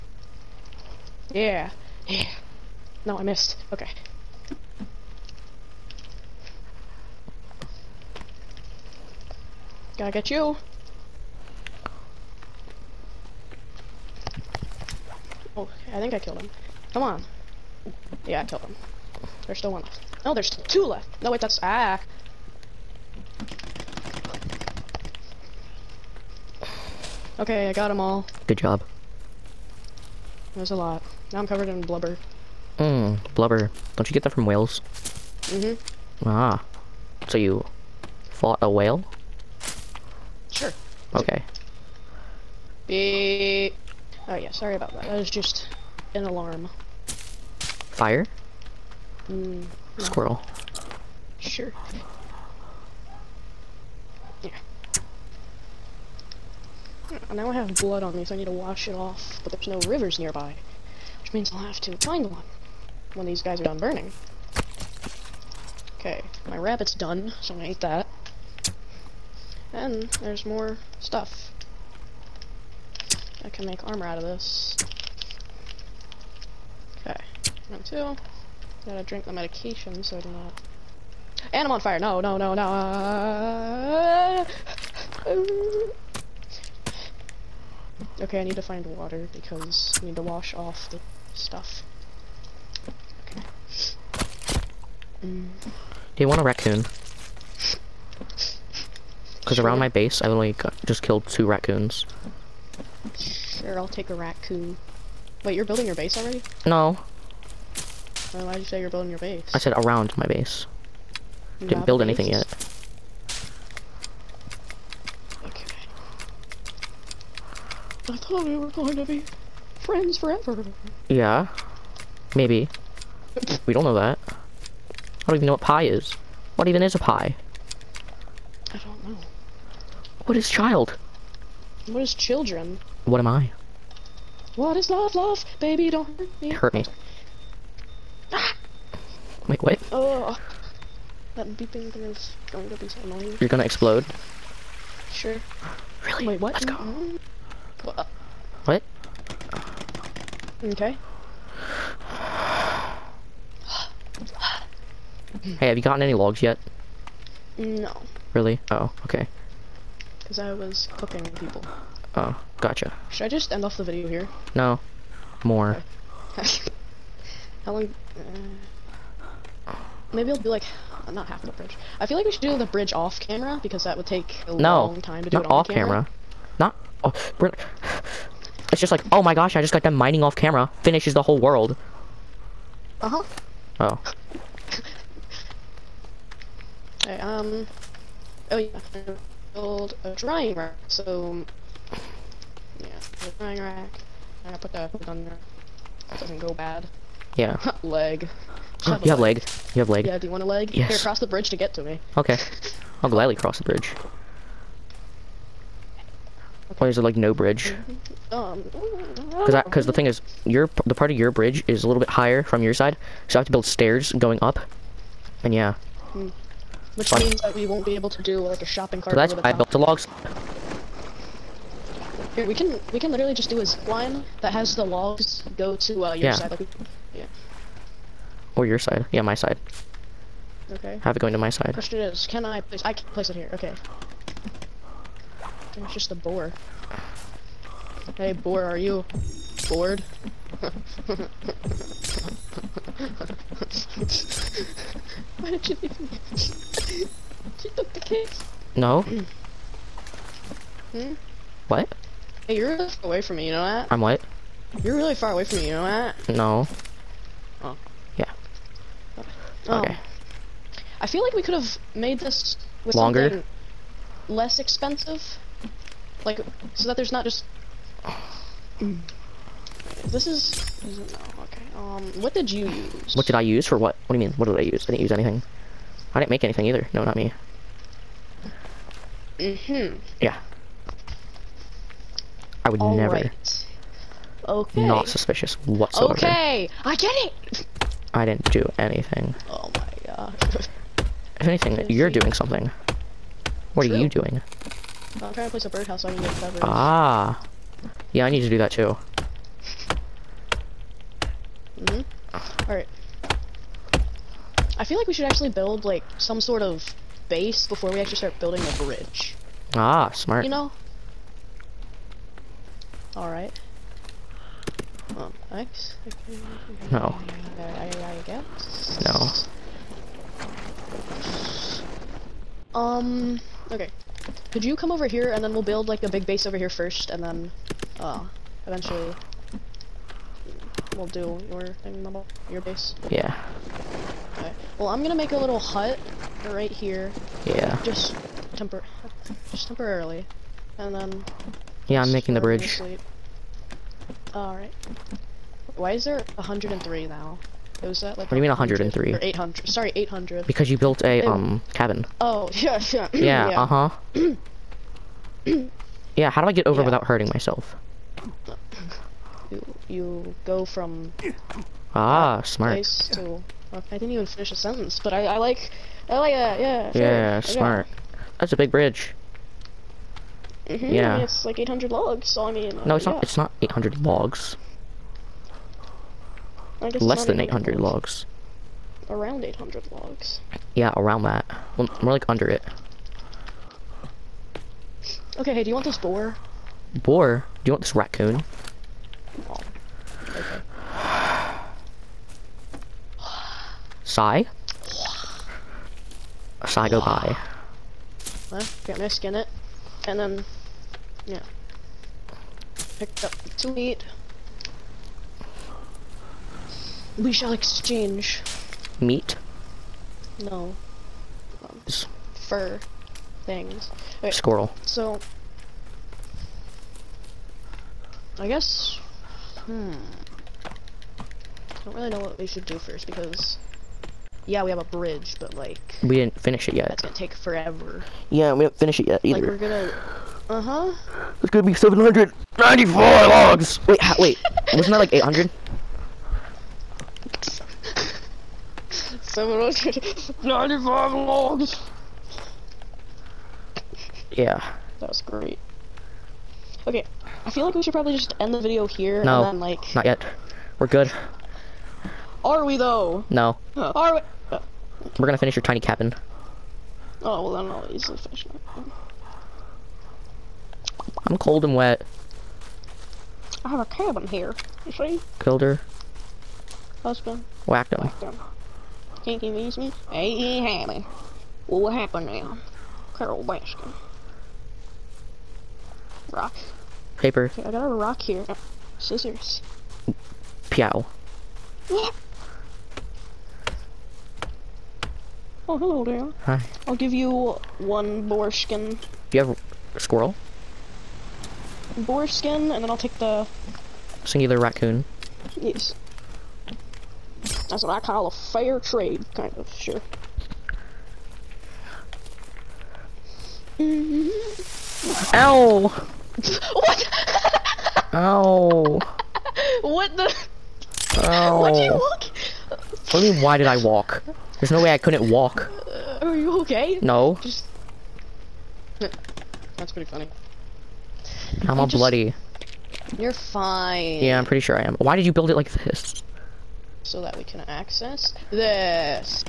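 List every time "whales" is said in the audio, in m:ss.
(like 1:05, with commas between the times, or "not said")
0:34, 0:38.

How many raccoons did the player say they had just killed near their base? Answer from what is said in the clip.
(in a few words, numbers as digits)
2.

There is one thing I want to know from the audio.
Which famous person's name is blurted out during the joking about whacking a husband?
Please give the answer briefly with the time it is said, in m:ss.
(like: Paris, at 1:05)
Carole Baskin, at 7:53.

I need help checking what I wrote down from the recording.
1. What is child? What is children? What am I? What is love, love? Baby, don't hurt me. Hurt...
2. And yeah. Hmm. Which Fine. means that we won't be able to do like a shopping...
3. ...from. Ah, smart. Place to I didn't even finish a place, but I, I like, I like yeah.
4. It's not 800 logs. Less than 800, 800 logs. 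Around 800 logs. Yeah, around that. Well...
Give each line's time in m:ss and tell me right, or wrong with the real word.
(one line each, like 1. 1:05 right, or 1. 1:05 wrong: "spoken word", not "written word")
1. 2:10 right
2. 3:35 right
3. 6:00 wrong: "sentence", not "place"
4. 6:13 right.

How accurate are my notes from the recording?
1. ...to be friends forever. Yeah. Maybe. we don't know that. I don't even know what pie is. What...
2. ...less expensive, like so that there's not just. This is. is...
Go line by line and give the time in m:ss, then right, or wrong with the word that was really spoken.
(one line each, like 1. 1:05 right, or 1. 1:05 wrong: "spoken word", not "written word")
1. 1:58 right
2. 4:24 right.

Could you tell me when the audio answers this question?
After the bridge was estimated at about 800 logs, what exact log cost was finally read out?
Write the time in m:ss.
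7:19.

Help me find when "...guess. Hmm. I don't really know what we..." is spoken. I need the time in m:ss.
6:58.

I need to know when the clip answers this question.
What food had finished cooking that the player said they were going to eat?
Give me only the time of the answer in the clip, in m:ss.
1:06.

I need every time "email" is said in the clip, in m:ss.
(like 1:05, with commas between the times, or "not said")
not said.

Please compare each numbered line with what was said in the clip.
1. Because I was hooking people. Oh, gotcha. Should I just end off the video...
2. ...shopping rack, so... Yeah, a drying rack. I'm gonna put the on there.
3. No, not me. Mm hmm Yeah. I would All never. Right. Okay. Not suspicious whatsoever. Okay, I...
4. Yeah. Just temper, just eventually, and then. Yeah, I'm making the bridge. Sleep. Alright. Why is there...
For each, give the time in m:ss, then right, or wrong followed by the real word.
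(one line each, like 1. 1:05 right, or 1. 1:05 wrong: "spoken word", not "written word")
1. 2:40 right
2. 3:10 wrong: "drying", not "shopping"
3. 4:36 right
4. 5:37 wrong: "temporarily", not "eventually".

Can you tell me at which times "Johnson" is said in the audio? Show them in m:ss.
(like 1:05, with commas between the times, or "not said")
not said.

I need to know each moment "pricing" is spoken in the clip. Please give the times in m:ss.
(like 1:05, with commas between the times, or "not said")
not said.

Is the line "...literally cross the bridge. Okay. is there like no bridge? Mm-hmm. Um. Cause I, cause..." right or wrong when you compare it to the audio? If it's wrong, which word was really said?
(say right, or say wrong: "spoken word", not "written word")
wrong: "gladly", not "literally".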